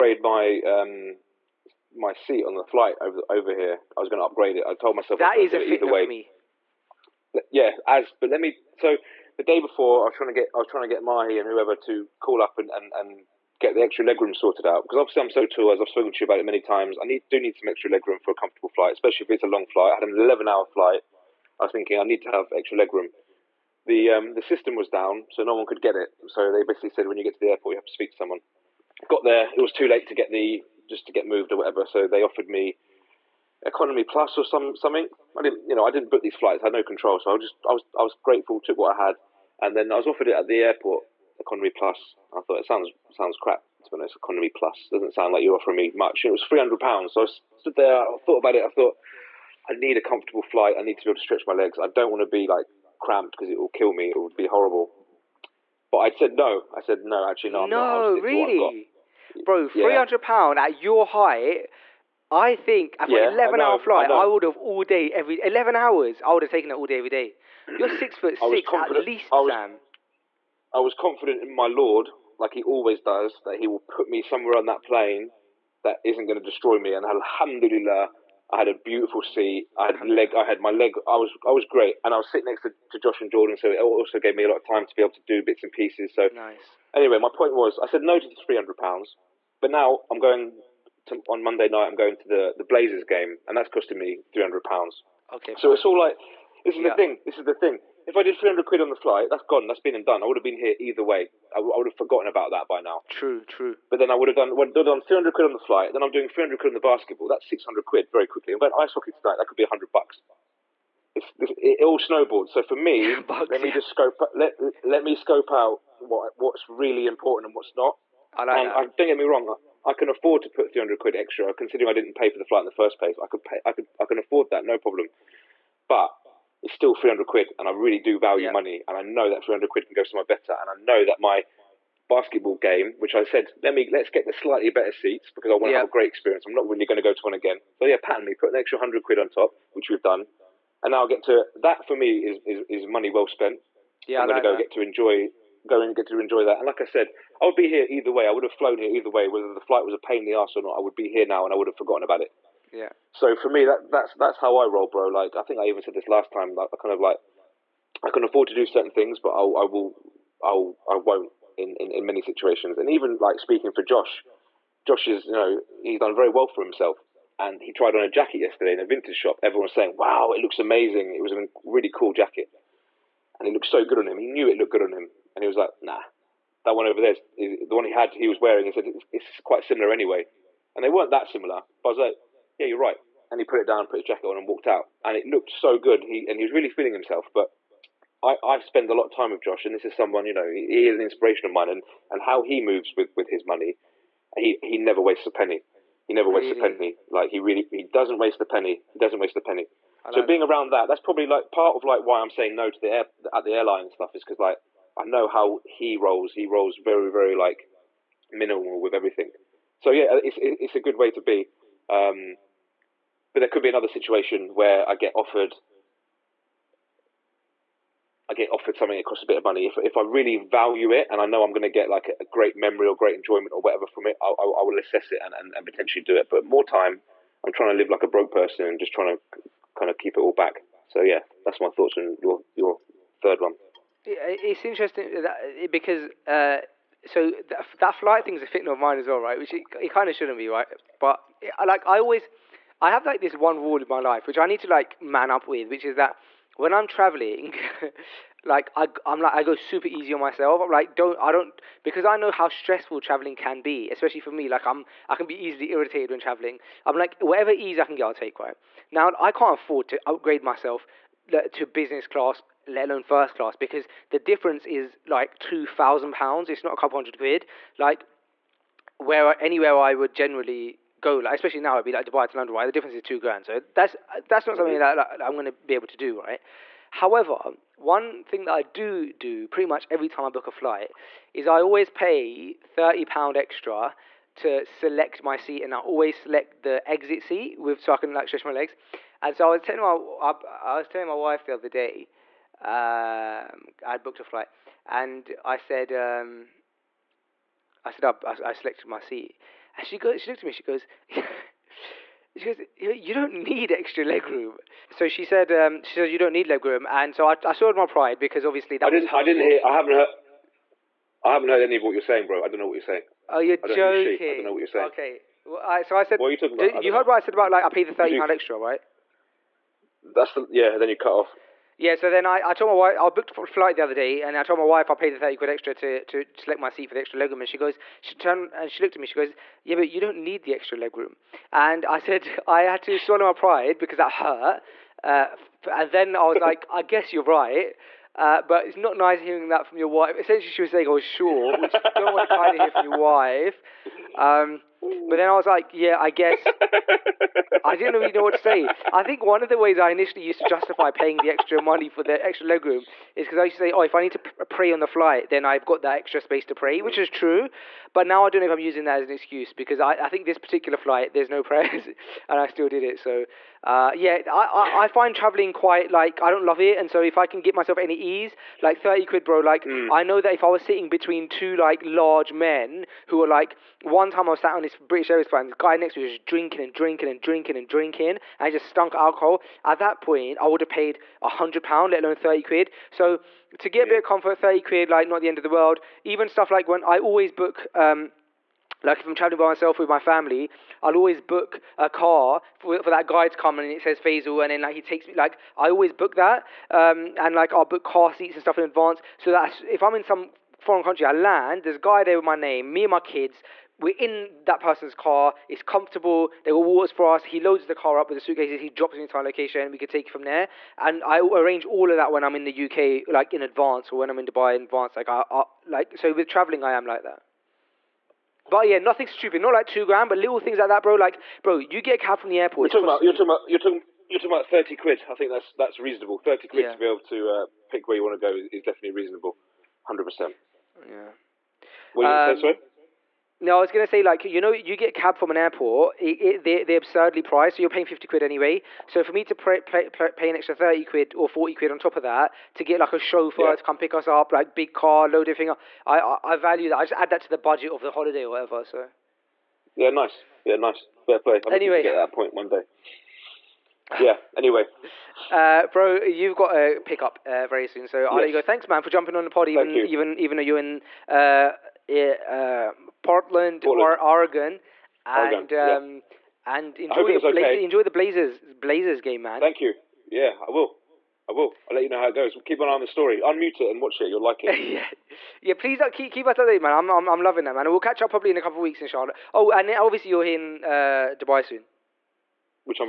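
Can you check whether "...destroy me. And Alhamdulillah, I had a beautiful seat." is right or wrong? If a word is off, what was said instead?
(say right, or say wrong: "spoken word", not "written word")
right.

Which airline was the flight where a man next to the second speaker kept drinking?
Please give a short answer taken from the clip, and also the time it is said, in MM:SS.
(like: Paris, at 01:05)
British Airways, at 06:14.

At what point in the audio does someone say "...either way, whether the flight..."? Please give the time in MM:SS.
02:28.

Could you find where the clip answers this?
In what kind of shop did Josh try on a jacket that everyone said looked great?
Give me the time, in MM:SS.
02:48.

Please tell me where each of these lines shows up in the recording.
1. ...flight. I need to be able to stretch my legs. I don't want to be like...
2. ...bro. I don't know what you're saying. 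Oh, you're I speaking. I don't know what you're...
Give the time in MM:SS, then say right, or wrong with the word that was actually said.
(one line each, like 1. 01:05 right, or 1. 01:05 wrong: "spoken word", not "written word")
1. 00:50 right
2. 05:12 wrong: "joking", not "speaking".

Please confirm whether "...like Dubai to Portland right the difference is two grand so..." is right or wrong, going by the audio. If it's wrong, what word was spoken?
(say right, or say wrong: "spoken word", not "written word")
wrong: "London", not "Portland".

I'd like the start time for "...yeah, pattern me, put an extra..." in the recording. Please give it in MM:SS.
02:17.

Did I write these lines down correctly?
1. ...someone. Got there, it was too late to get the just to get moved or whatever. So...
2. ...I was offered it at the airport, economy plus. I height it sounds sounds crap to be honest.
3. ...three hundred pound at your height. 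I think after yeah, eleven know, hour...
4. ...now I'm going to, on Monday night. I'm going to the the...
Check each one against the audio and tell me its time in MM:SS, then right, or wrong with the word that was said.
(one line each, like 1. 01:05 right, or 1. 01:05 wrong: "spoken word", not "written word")
1. 00:28 right
2. 00:39 wrong: "thought", not "height"
3. 00:59 right
4. 01:29 right.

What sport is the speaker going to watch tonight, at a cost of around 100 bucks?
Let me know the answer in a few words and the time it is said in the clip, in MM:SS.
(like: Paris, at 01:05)
Ice hockey, at 01:48.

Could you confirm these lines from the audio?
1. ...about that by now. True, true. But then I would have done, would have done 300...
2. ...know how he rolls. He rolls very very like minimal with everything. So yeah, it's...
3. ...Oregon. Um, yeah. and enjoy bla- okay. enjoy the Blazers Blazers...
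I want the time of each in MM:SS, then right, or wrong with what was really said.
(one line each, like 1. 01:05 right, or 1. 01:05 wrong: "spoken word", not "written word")
1. 01:42 right
2. 03:25 right
3. 07:45 right.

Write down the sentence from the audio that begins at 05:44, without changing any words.
Um, but then I was like, yeah, I guess I didn't really know what to say.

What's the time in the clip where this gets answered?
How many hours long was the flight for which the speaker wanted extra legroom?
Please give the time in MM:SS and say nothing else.
00:20.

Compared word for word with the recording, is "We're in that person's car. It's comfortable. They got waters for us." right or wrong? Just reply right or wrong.
right.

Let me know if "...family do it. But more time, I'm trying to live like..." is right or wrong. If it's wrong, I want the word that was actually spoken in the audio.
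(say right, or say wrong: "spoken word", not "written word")
wrong: "potentially", not "family".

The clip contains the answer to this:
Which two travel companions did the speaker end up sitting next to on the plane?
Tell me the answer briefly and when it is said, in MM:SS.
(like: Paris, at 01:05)
Josh and Jordan, at 01:22.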